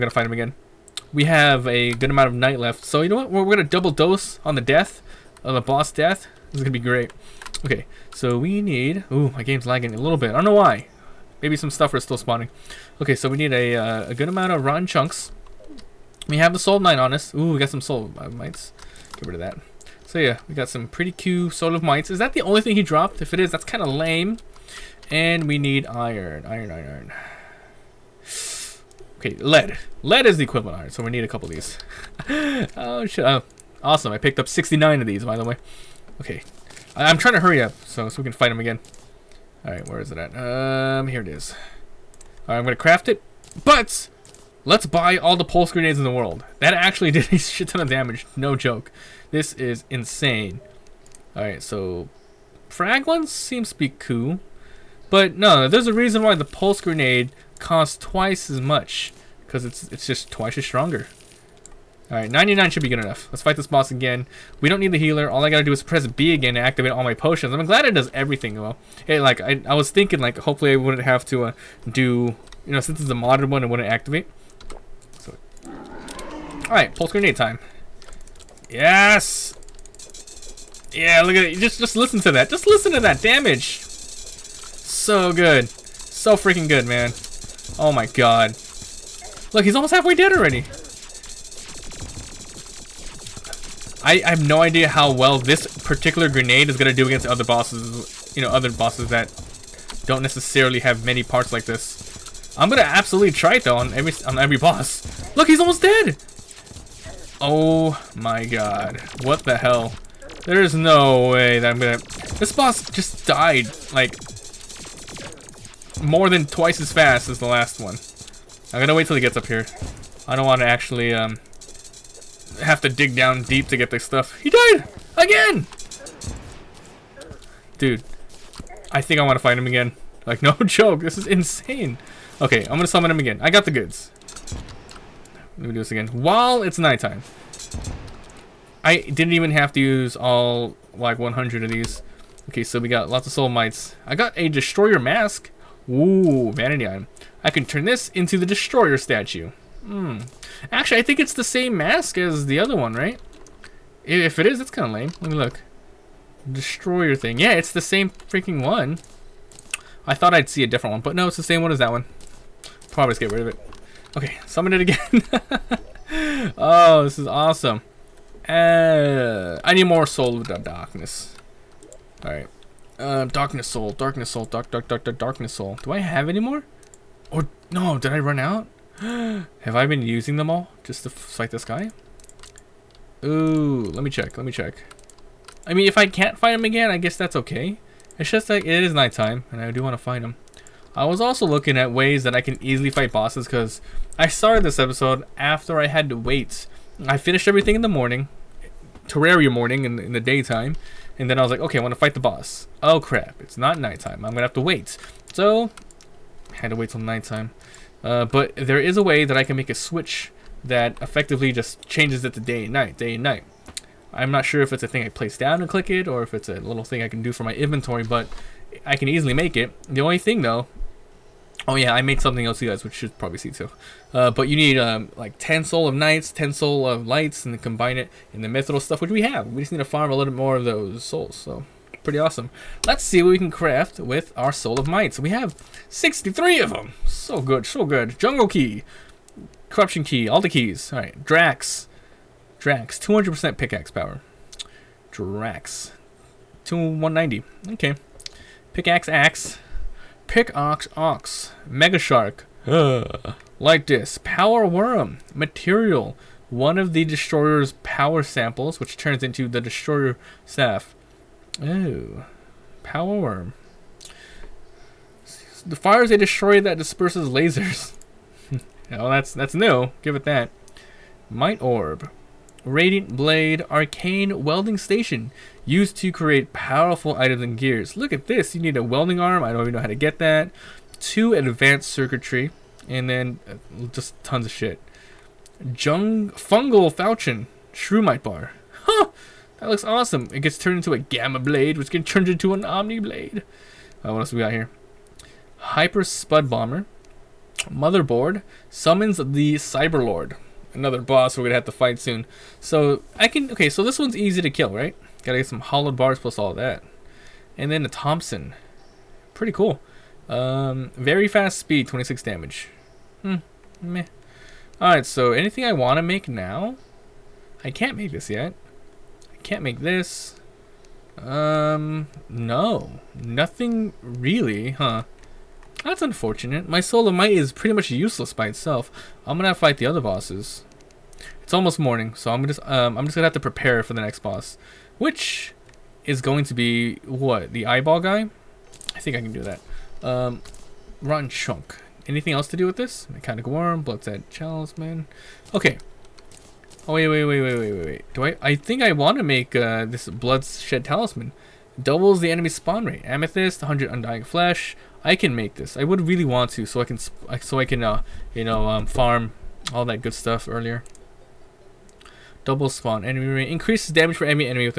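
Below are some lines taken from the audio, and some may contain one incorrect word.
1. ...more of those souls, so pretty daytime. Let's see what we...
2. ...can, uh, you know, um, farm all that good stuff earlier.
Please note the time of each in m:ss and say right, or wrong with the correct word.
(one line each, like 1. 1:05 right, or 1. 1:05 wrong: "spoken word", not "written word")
1. 3:50 wrong: "awesome", not "daytime"
2. 5:57 right.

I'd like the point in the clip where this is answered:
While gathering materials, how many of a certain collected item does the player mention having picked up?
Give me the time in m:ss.
0:34.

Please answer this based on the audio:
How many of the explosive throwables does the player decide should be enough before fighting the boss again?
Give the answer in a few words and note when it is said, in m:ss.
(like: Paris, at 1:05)
99, at 1:02.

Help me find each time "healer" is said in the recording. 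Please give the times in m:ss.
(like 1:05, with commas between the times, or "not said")
1:04.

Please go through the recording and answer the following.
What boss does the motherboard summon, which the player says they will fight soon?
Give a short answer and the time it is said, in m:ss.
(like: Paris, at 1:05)
Cyberlord, at 4:59.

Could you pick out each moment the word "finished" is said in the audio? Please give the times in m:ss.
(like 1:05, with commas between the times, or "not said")
3:17.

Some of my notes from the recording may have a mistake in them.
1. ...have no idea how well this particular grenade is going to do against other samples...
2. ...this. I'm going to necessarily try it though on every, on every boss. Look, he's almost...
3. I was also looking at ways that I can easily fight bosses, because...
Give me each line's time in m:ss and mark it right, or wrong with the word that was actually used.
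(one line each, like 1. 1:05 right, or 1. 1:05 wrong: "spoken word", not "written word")
1. 1:34 wrong: "bosses", not "samples"
2. 1:41 wrong: "absolutely", not "necessarily"
3. 3:10 right.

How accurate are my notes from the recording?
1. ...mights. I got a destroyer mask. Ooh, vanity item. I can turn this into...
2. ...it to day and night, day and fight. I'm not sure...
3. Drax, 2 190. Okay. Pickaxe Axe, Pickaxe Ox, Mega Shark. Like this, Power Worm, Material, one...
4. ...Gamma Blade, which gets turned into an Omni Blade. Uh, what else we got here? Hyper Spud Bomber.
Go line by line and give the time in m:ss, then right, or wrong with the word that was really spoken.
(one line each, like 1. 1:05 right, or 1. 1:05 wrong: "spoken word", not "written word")
1. 2:23 right
2. 3:32 wrong: "night", not "fight"
3. 4:05 right
4. 4:50 right.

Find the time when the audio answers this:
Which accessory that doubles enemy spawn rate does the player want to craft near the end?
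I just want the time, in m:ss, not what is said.
5:50.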